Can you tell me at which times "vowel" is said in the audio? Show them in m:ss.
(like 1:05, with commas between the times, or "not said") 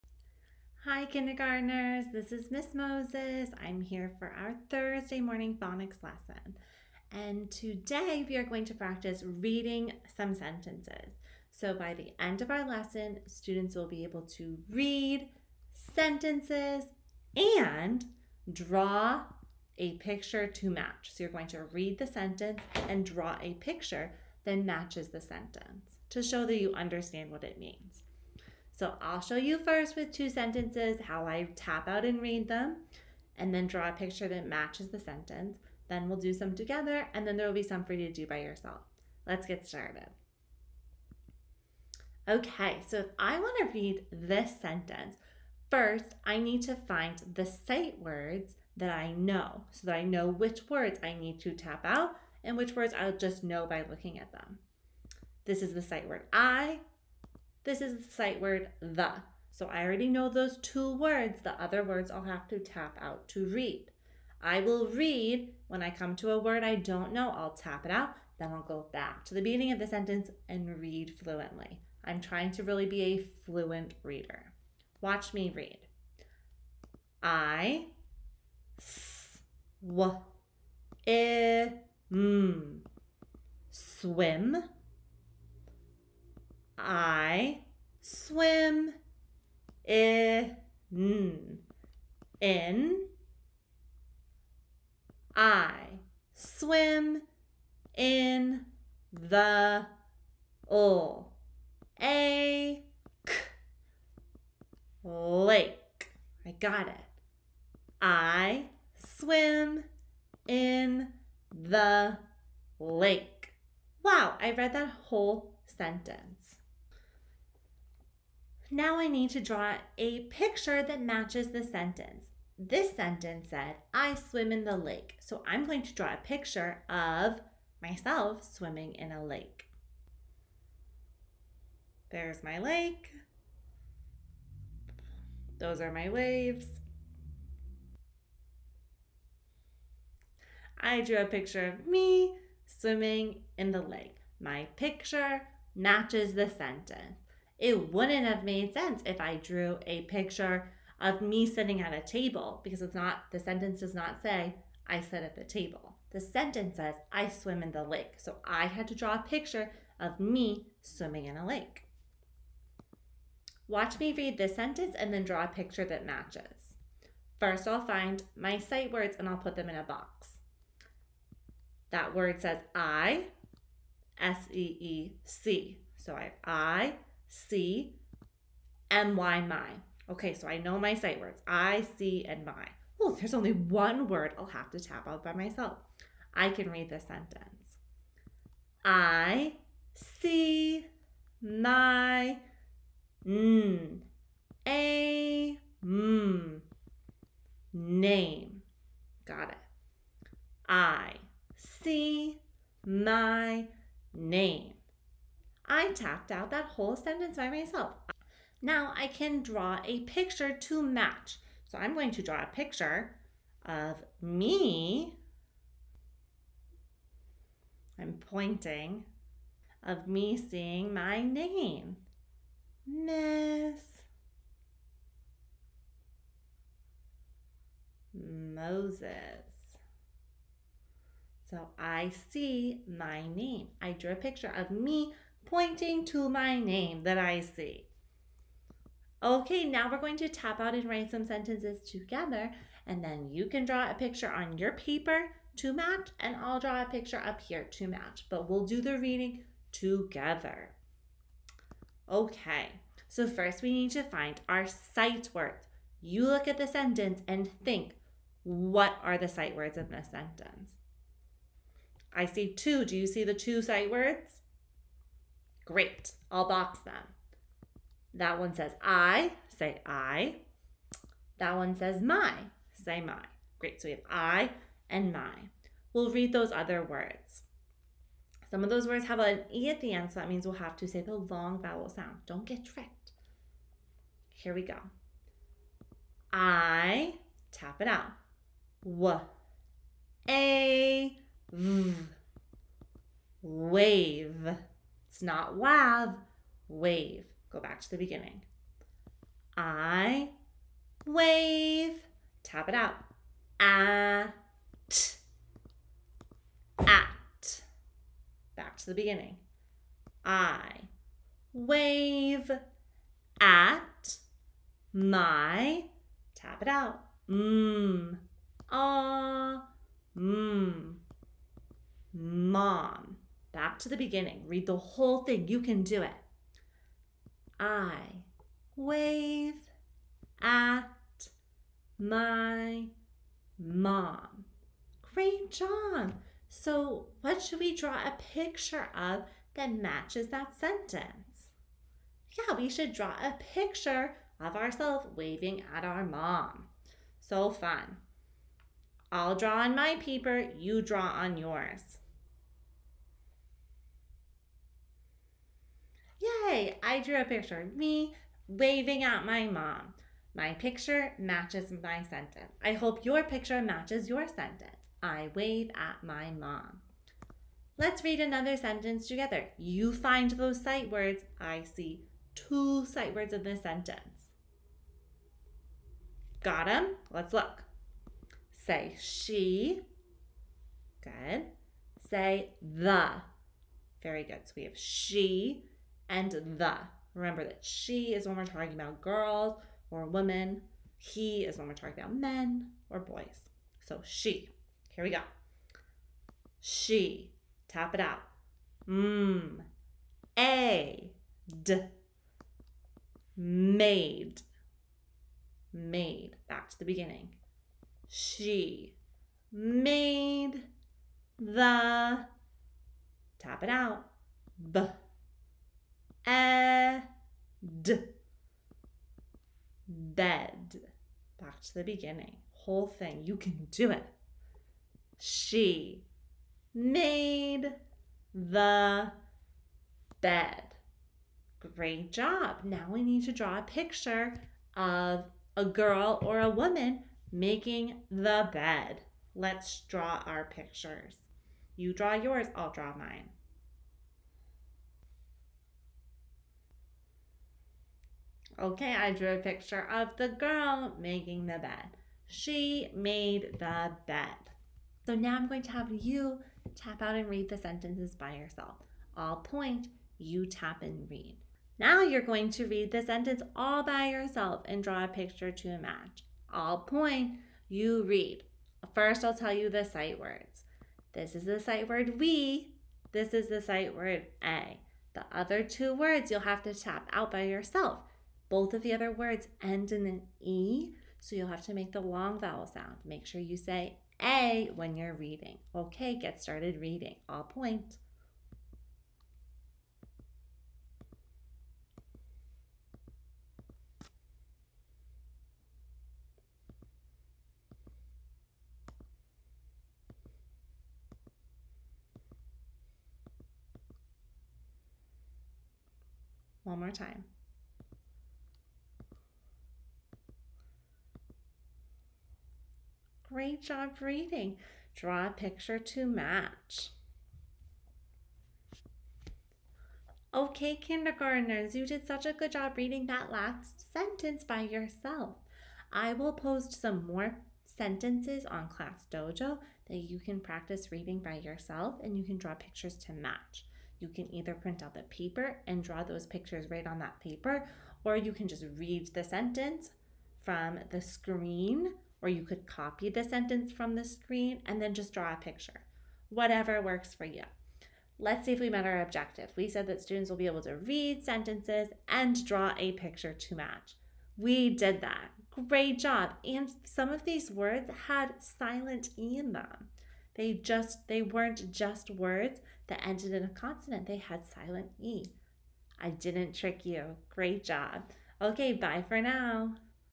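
4:41, 8:02.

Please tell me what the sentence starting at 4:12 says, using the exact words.
Okay, so first we need to find our sight words.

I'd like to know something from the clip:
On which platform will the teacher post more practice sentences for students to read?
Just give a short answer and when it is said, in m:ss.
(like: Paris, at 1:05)
Class Dojo, at 8:48.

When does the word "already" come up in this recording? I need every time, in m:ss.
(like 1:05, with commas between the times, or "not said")
0:59.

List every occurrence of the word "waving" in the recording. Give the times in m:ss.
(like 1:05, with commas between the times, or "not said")
5:45, 5:58.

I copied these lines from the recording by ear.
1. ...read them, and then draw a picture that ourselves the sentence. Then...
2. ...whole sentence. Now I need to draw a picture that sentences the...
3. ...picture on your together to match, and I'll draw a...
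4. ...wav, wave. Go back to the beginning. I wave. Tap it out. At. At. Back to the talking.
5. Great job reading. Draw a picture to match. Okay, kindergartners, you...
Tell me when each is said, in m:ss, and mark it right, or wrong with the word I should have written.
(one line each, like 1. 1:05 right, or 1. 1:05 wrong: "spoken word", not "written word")
1. 0:32 wrong: "matches", not "ourselves"
2. 1:55 wrong: "matches", not "sentences"
3. 4:03 wrong: "paper", not "together"
4. 4:55 wrong: "beginning", not "talking"
5. 8:33 right.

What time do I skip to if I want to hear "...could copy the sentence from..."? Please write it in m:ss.
9:02.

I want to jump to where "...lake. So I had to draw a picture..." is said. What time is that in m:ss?
2:37.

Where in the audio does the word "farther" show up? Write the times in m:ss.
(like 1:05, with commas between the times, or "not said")
not said.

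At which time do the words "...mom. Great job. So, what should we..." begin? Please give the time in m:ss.
5:33.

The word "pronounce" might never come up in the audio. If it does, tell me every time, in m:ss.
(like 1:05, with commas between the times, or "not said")
not said.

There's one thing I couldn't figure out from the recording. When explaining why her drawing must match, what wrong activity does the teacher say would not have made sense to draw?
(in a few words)
sitting at a table.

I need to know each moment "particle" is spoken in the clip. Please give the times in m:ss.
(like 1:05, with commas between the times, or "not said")
not said.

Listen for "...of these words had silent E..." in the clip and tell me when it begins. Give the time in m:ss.
9:17.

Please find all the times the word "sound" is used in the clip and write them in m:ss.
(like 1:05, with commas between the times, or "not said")
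4:41, 8:02.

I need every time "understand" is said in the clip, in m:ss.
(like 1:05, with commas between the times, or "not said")
0:26.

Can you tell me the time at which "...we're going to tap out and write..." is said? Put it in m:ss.
3:59.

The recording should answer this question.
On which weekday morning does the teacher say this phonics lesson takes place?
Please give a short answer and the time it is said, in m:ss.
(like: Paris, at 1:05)
Thursday, at 0:04.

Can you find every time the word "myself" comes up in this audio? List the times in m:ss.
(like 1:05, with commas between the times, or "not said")
2:07, 3:05, 3:27.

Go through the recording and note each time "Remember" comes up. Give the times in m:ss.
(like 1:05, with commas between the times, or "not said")
6:27.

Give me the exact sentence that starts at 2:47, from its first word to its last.
First, I'll find my sight words and I'll put them in a box.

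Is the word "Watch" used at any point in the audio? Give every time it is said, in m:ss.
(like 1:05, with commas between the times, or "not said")
1:15, 2:43.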